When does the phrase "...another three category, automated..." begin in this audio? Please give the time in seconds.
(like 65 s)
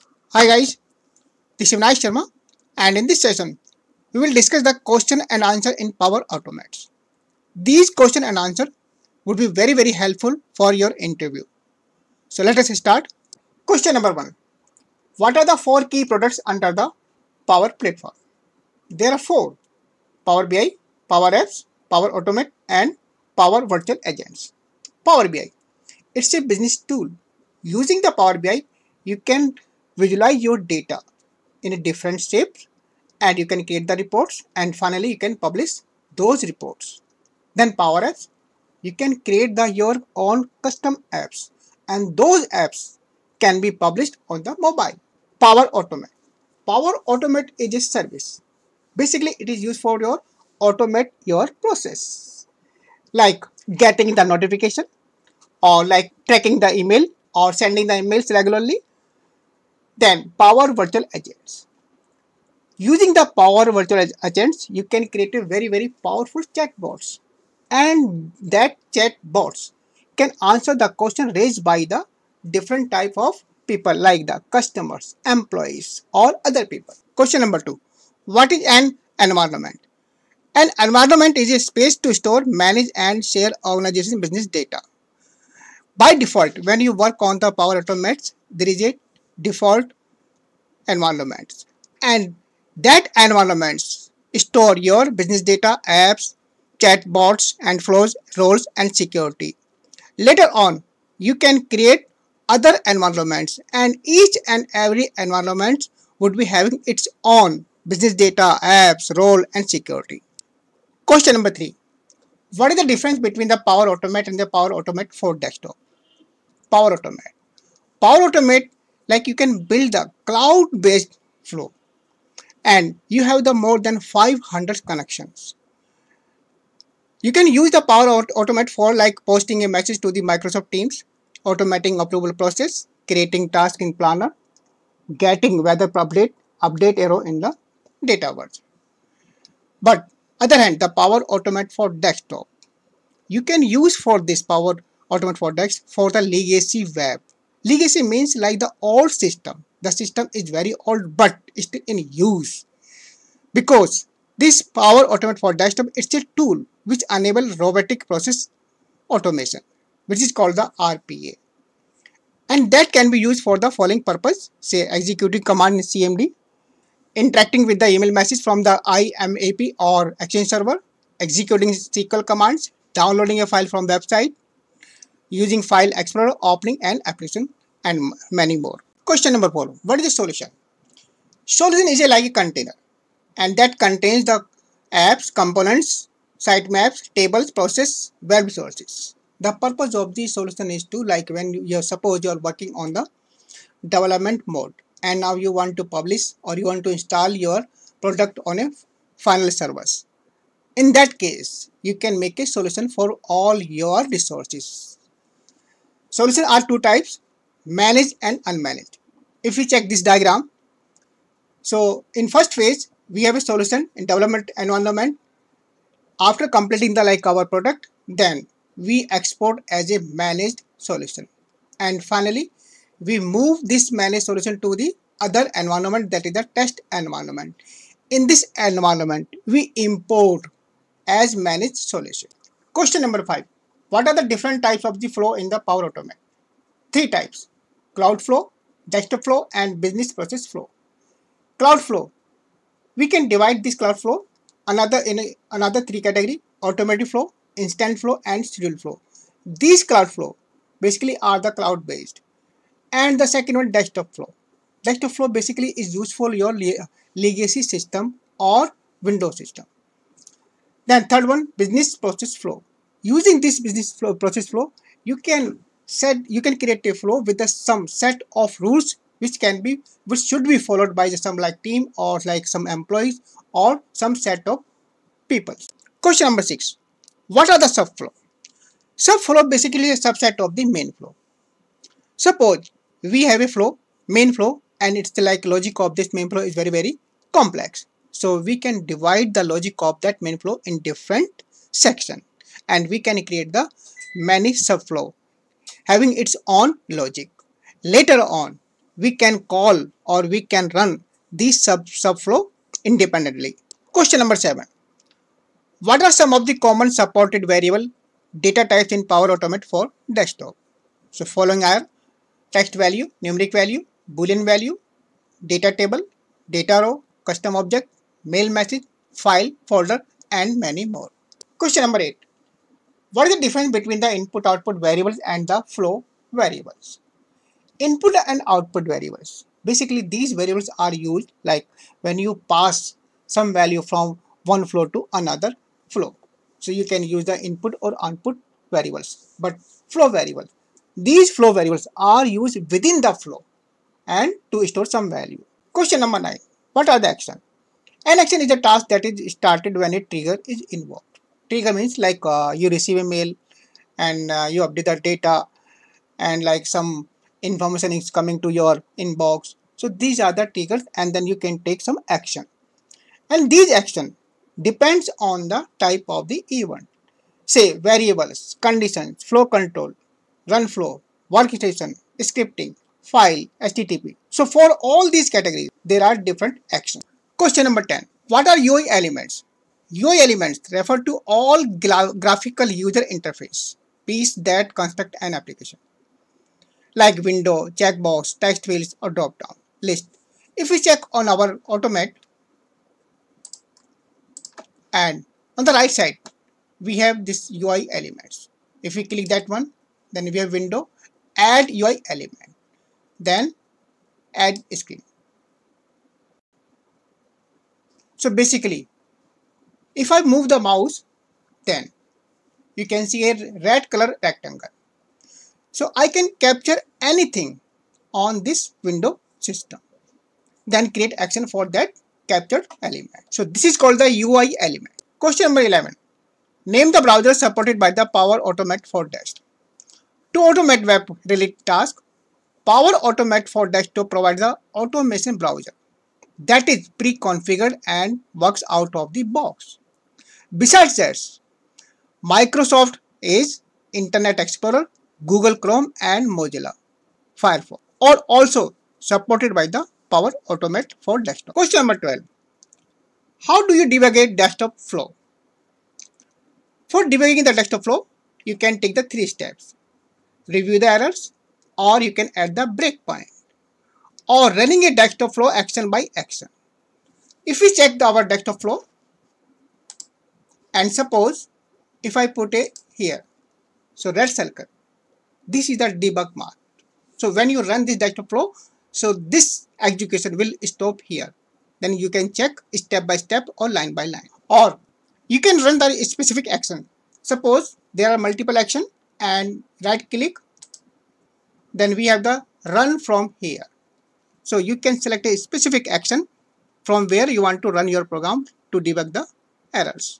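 245 s.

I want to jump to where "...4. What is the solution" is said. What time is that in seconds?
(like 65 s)
179 s.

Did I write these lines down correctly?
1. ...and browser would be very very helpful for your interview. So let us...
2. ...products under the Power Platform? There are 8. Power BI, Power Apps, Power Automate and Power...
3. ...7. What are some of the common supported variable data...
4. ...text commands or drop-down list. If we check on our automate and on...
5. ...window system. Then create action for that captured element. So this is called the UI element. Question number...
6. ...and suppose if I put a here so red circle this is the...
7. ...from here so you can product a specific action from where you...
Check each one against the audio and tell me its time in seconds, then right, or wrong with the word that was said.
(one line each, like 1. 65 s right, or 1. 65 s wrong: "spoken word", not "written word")
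1. 8 s wrong: "answer", not "browser"
2. 16 s wrong: "4", not "8"
3. 304 s right
4. 388 s wrong: "fields", not "commands"
5. 418 s right
6. 470 s right
7. 492 s wrong: "select", not "product".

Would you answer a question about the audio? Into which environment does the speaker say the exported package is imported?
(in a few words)
test environment.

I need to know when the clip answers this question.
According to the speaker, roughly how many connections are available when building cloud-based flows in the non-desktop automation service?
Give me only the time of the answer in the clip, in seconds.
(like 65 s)
123 s.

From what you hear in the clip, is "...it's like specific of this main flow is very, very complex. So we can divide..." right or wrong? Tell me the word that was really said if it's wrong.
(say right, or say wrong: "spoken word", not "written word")
wrong: "logic", not "specific".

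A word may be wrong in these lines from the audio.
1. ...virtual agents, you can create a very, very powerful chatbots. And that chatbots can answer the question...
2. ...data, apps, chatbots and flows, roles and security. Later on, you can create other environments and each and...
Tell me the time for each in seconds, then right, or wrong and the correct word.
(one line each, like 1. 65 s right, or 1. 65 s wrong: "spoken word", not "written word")
1. 63 s right
2. 95 s right.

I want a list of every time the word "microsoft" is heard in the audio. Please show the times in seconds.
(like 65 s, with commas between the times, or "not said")
130 s, 442 s.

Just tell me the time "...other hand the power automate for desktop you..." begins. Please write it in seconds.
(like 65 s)
140 s.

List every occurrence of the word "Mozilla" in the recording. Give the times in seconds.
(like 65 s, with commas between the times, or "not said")
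446 s.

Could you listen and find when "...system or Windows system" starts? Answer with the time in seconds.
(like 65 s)
257 s.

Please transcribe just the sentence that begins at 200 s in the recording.
In that case, you can make a solution for all your resources Solutions are two types, managed and unmanaged.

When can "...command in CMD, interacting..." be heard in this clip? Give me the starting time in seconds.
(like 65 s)
165 s.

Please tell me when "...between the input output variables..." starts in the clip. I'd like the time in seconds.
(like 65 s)
323 s.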